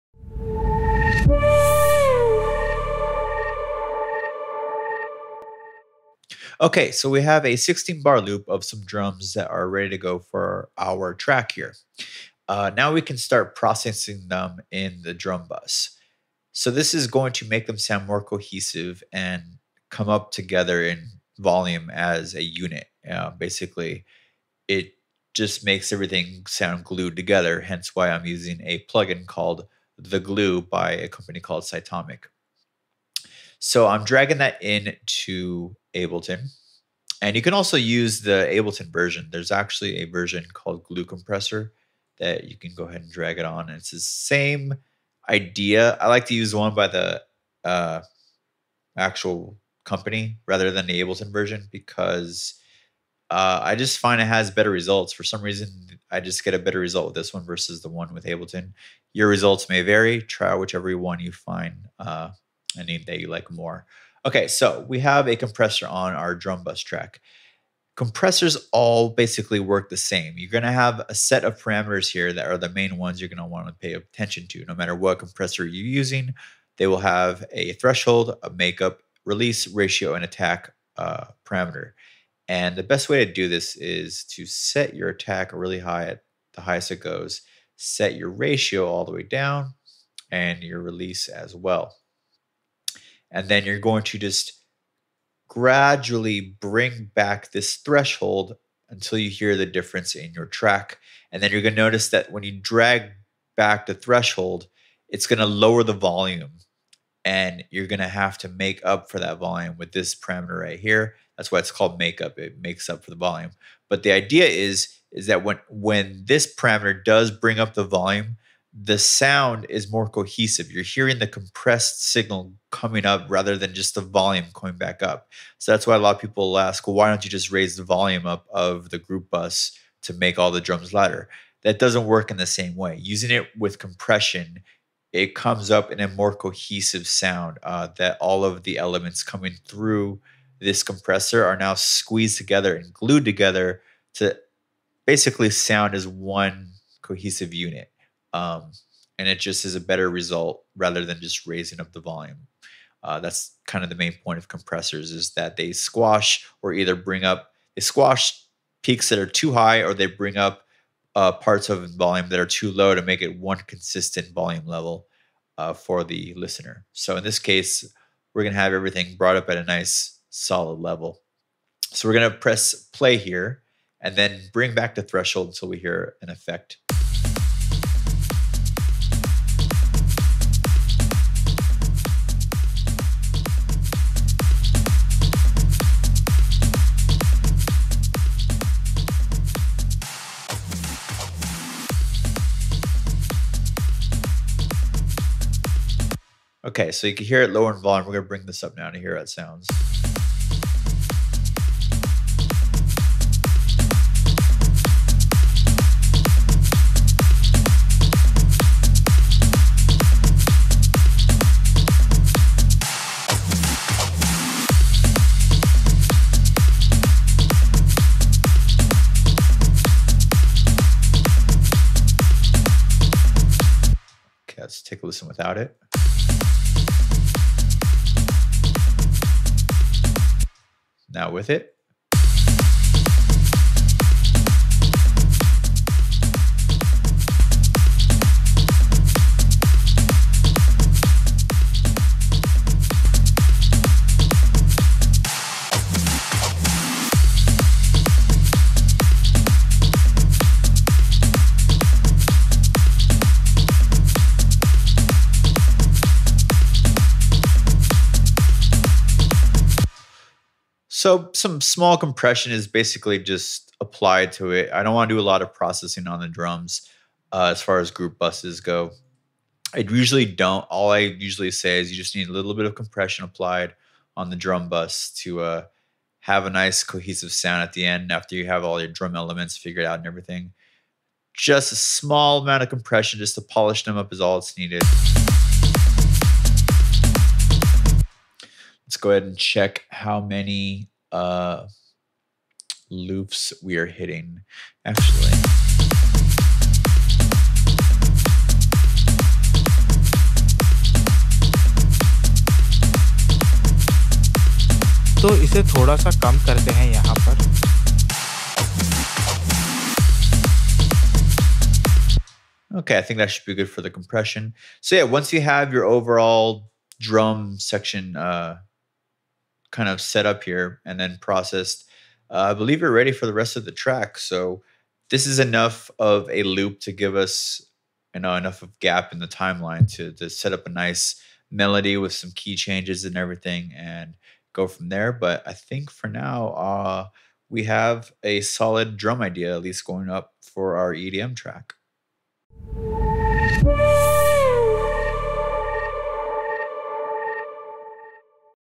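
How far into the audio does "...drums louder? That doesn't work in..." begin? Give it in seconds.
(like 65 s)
130 s.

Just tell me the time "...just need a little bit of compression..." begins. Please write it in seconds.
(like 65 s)
271 s.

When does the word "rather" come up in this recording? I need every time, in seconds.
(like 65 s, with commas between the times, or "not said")
50 s, 123 s, 150 s.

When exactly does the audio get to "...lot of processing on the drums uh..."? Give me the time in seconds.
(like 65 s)
265 s.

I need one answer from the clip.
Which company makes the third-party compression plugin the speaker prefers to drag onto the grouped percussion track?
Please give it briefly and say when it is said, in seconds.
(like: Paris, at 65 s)
Cytomic, at 31 s.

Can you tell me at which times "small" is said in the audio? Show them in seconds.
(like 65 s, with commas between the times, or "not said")
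261 s, 281 s.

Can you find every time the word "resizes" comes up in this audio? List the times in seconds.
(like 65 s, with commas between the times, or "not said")
not said.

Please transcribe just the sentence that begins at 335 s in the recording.
But I think for now, uh, we have a solid drum idea at least going up for our EDM track.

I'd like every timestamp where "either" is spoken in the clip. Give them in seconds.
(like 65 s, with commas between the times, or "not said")
156 s.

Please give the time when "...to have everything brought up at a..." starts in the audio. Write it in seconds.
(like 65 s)
168 s.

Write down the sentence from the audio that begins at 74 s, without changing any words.
No matter what compressor you're using, they will have a threshold, a makeup, release, ratio, and attack uh, parameter.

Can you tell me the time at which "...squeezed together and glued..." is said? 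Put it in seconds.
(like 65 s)
141 s.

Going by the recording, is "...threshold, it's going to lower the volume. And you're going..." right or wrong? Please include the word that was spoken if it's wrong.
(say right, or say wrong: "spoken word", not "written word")
right.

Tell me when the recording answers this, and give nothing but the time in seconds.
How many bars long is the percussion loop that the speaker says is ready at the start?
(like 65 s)
7 s.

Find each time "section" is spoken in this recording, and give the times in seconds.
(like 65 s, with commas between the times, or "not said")
317 s.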